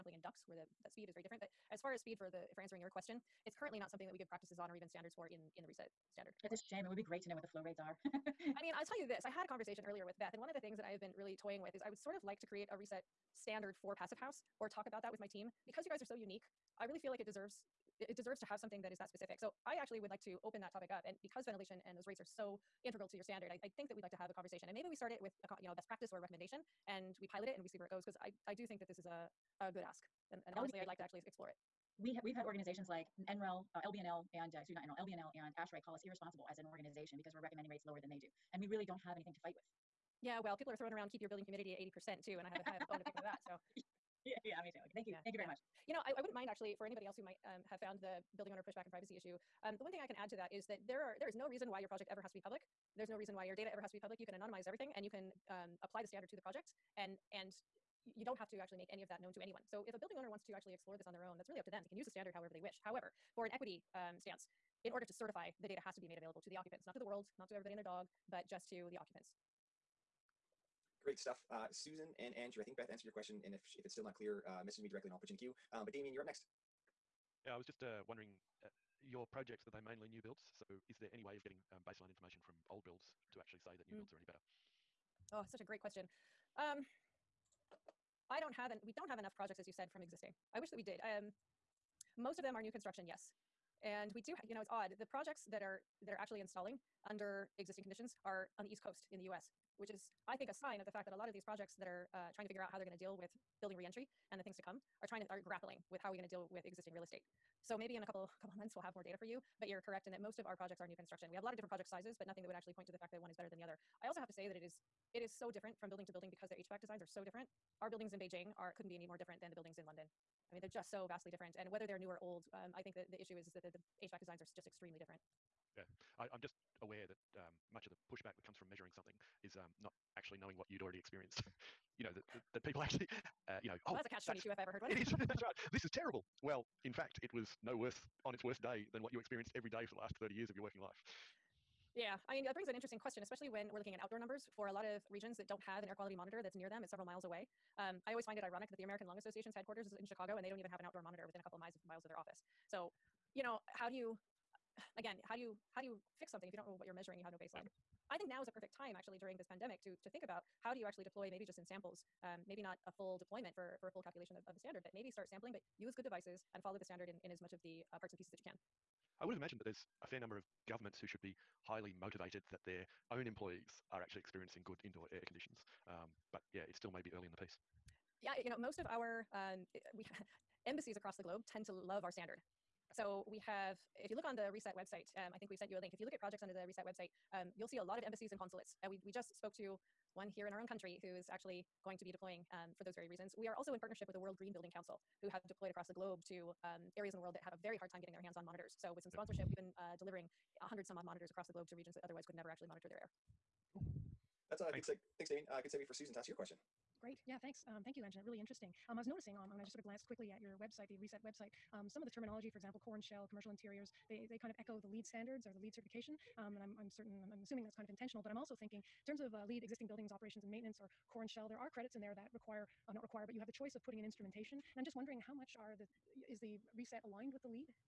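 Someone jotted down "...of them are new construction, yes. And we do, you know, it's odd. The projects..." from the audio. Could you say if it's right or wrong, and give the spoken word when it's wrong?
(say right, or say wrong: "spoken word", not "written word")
right.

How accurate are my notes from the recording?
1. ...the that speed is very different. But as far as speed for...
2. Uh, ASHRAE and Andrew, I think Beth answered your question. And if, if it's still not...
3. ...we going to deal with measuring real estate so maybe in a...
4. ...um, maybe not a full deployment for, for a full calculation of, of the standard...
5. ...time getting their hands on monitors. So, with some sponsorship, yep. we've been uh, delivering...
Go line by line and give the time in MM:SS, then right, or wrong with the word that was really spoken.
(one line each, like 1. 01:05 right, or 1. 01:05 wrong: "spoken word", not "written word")
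1. 00:00 right
2. 01:11 wrong: "Susan", not "ASHRAE"
3. 01:46 wrong: "existing", not "measuring"
4. 02:42 right
5. 03:17 right.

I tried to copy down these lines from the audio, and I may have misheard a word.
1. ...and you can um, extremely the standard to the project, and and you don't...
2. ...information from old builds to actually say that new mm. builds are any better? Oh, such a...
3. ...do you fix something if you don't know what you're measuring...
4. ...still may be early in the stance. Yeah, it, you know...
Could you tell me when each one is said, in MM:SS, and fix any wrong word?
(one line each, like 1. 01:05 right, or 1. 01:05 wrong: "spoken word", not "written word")
1. 00:54 wrong: "apply", not "extremely"
2. 01:22 right
3. 02:35 right
4. 02:56 wrong: "piece", not "stance".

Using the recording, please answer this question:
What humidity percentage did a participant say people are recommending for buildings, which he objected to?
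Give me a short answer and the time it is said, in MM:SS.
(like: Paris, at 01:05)
80 percent, at 00:41.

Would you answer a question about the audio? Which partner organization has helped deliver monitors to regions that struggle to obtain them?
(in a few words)
World Green Building Council.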